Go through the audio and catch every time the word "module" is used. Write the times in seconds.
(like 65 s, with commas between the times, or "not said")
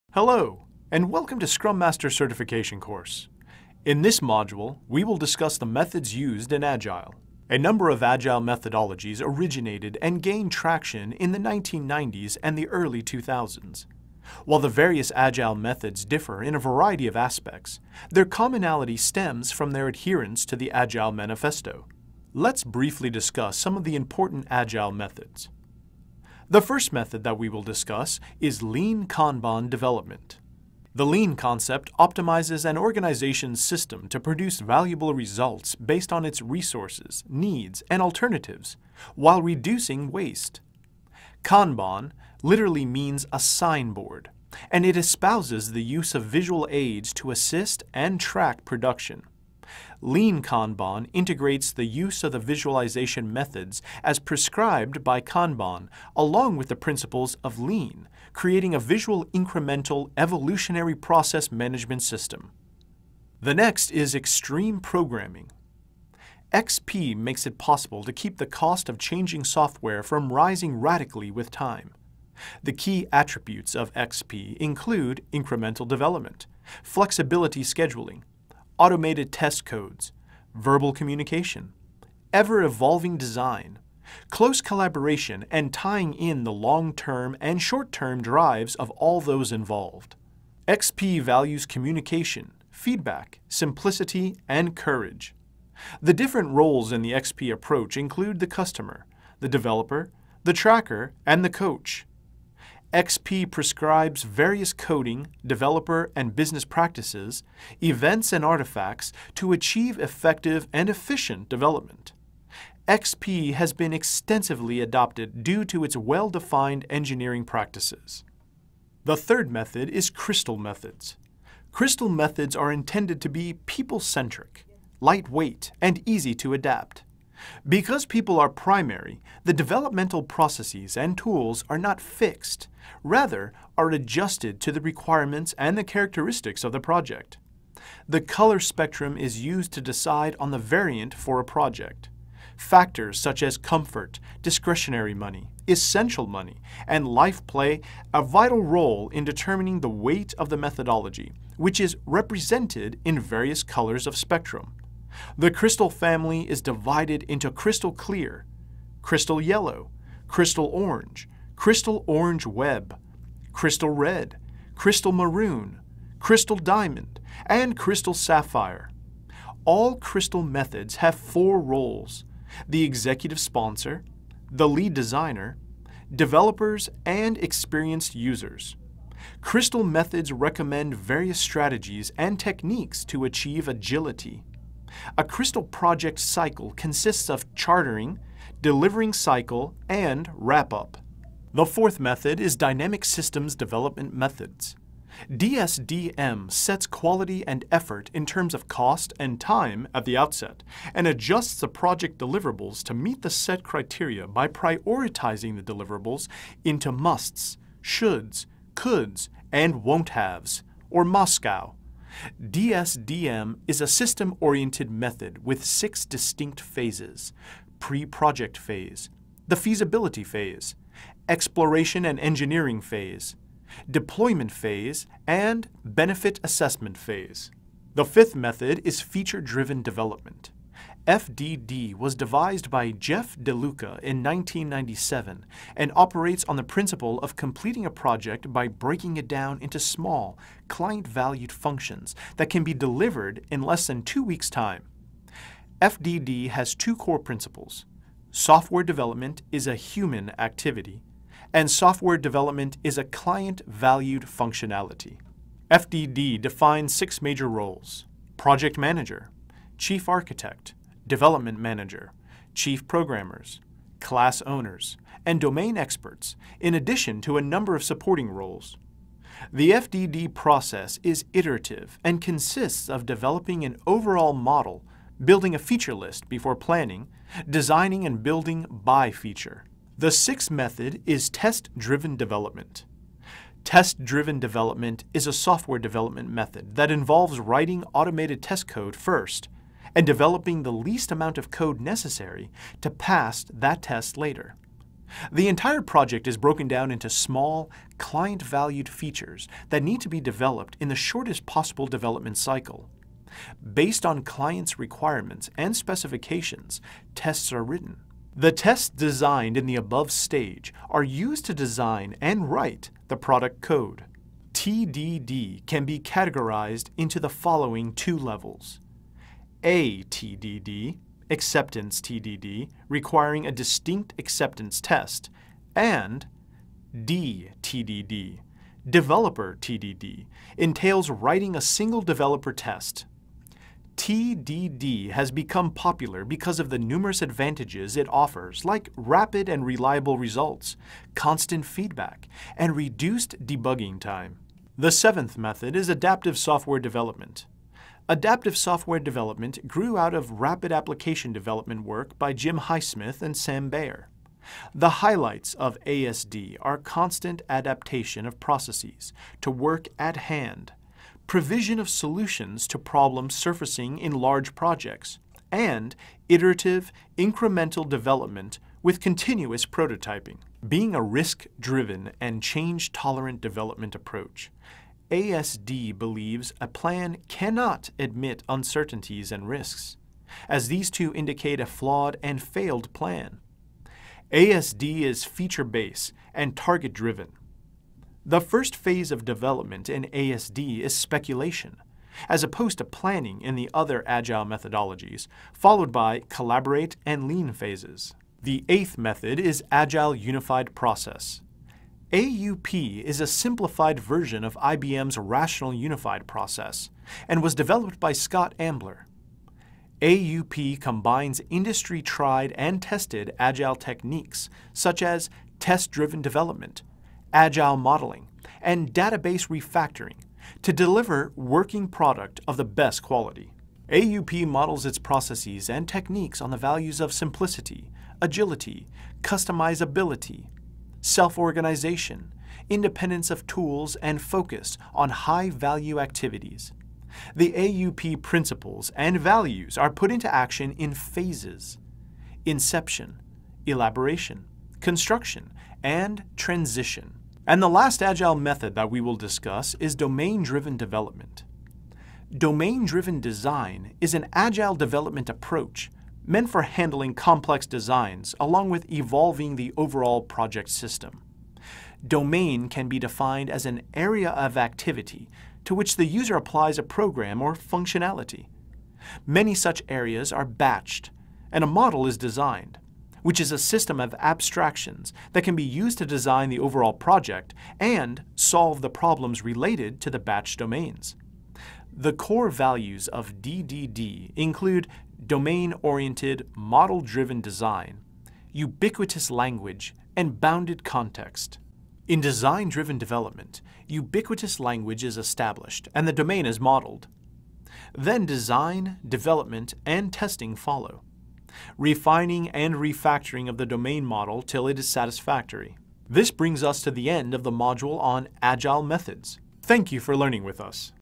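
4 s, 507 s.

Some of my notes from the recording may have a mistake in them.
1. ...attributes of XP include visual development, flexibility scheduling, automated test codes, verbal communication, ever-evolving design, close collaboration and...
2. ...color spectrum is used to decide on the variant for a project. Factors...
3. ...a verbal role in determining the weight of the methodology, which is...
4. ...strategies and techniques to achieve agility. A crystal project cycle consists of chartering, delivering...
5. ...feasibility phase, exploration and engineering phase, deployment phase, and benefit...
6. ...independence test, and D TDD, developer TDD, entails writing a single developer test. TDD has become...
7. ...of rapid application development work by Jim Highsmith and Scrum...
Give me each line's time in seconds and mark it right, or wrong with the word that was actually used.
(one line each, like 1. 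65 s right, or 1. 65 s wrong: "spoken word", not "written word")
1. 73 s wrong: "incremental", not "visual"
2. 138 s right
3. 148 s wrong: "vital", not "verbal"
4. 181 s right
5. 219 s right
6. 324 s wrong: "acceptance", not "independence"
7. 350 s wrong: "Sam", not "Scrum".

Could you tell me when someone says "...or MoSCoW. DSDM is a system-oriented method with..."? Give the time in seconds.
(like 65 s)
210 s.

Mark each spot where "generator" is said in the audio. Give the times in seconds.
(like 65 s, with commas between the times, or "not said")
not said.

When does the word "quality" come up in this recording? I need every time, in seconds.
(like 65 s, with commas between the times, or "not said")
196 s, 423 s.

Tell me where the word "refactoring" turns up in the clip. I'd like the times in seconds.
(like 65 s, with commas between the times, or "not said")
419 s, 502 s.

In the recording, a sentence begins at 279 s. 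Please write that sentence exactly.
The sixth method is test-driven development.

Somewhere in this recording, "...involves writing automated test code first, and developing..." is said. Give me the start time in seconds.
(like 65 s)
286 s.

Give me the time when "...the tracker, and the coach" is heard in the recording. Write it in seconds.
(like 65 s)
100 s.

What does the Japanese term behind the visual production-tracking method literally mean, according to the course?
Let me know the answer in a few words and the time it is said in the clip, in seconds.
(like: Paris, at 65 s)
A signboard, at 43 s.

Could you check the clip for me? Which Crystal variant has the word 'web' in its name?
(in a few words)
Crystal orange web.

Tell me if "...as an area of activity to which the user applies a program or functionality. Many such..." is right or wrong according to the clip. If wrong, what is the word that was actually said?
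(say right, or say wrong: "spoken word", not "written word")
right.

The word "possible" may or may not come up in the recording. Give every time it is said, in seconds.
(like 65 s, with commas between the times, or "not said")
67 s, 301 s.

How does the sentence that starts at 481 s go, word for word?
The core values of DDD include domain-oriented, model-driven design, ubiquitous language, and bounded context.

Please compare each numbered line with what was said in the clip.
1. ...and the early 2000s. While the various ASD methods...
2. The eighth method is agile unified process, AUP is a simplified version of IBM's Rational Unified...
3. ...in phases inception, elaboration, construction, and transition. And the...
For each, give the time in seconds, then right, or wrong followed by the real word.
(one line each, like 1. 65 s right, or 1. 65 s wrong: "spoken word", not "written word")
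1. 12 s wrong: "Agile", not "ASD"
2. 398 s right
3. 440 s right.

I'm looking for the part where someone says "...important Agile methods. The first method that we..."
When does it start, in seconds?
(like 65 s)
23 s.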